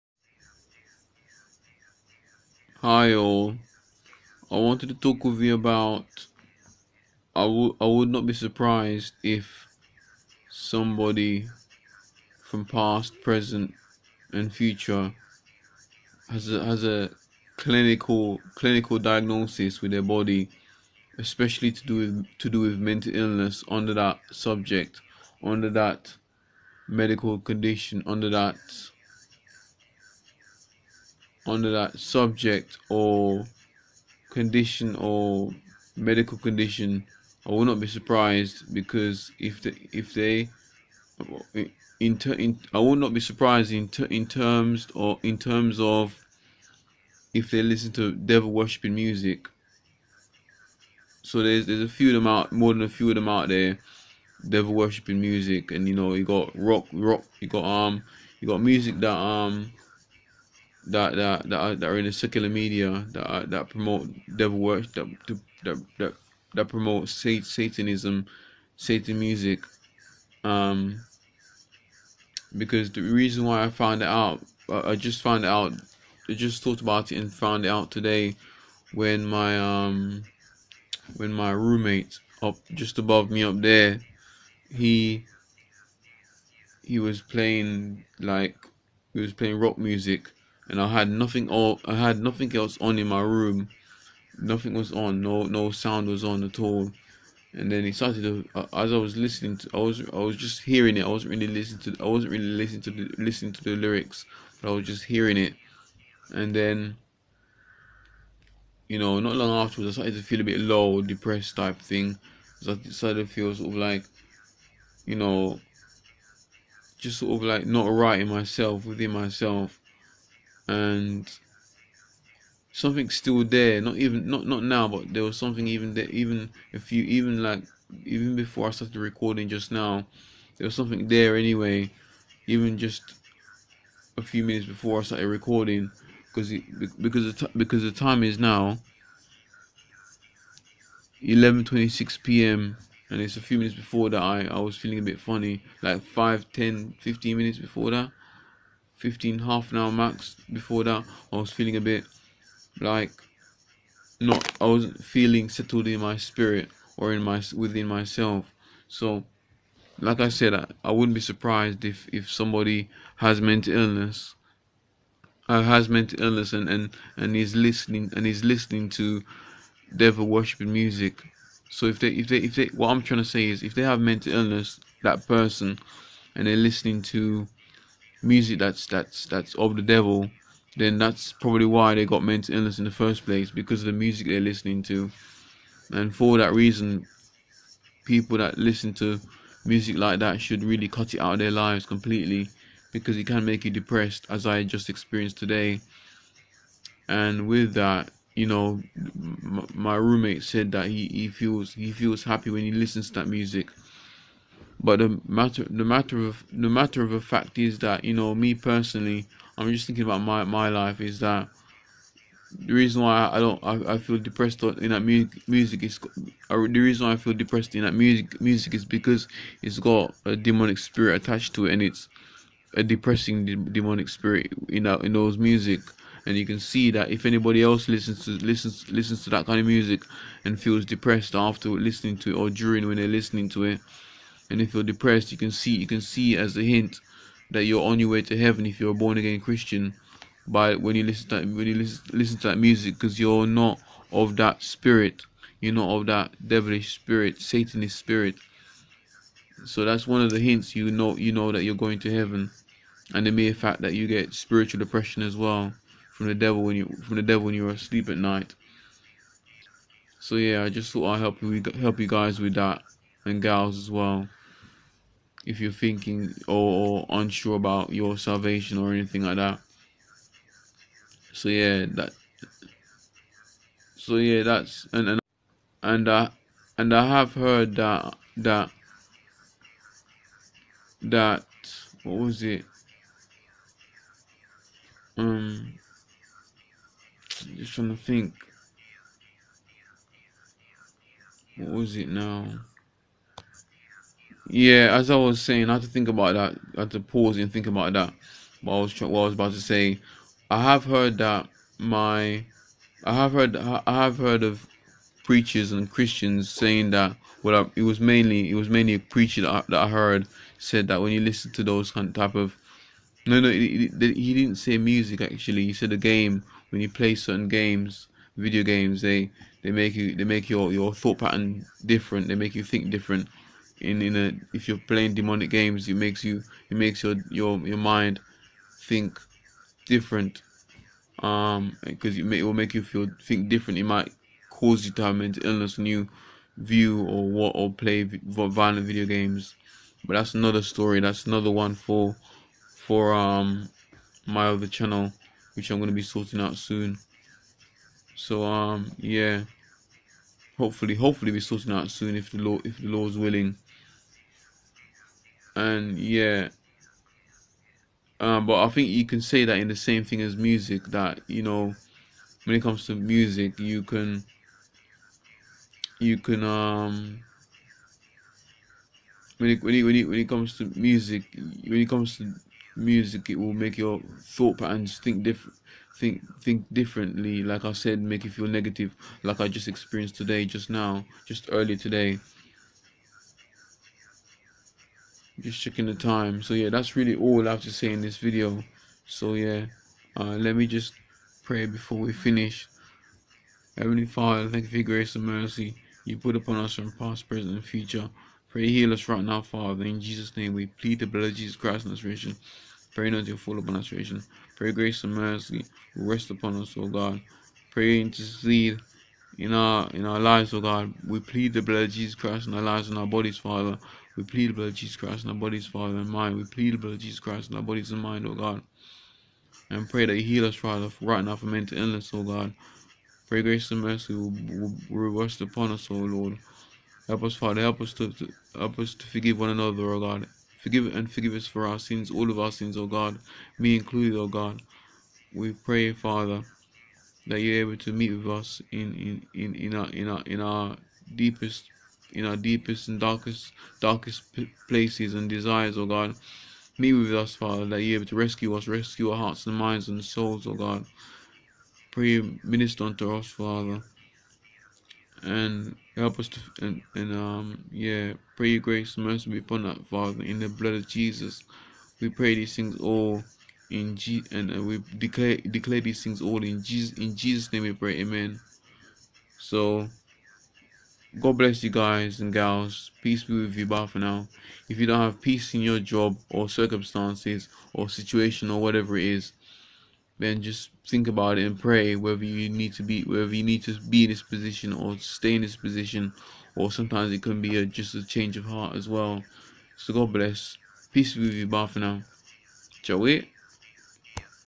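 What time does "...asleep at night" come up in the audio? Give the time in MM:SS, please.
04:17.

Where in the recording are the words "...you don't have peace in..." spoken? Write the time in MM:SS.
07:54.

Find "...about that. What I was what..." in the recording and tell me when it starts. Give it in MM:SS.
04:57.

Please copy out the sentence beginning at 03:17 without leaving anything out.
And with that, you know, my roommate said that he, he feels he feels happy when he listens to that music.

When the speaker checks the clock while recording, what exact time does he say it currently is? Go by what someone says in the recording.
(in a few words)
11:26 p.m.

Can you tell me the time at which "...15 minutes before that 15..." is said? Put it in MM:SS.
02:26.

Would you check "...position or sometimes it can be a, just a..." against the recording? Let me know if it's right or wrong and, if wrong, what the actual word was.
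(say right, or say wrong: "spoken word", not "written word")
right.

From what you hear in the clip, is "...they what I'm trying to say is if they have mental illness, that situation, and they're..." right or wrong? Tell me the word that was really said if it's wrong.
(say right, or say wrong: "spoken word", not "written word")
wrong: "person", not "situation".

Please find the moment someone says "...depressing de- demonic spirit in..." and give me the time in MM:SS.
03:42.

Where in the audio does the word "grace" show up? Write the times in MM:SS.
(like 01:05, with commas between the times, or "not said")
06:34, 06:44, 07:03, 07:38.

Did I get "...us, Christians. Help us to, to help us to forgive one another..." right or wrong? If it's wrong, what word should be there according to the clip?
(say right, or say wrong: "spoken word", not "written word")
wrong: "Father", not "Christians".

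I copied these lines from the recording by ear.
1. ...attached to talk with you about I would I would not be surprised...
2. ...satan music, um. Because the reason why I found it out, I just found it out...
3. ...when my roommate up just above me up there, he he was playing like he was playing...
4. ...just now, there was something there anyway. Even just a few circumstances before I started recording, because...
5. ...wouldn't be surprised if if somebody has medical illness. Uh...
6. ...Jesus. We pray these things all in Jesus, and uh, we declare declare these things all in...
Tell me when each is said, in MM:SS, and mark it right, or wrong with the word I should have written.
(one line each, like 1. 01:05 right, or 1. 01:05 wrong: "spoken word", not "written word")
1. 00:04 wrong: "wanted", not "attached"
2. 01:08 right
3. 01:21 right
4. 02:09 wrong: "minutes", not "circumstances"
5. 02:40 wrong: "mental", not "medical"
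6. 07:40 right.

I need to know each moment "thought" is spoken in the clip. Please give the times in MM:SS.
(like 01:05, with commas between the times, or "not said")
01:16, 04:20, 05:20, 06:14.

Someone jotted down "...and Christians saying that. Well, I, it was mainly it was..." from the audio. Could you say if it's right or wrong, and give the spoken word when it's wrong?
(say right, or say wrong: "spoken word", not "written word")
right.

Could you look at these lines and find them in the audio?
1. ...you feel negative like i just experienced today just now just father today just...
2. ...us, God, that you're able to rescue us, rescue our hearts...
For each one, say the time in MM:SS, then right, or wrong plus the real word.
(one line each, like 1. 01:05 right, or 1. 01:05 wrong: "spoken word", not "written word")
1. 06:18 wrong: "earlier", not "father"
2. 07:27 wrong: "Father", not "God".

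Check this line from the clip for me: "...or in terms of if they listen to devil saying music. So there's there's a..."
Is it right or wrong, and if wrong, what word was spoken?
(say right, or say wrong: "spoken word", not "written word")
wrong: "worshipping", not "saying".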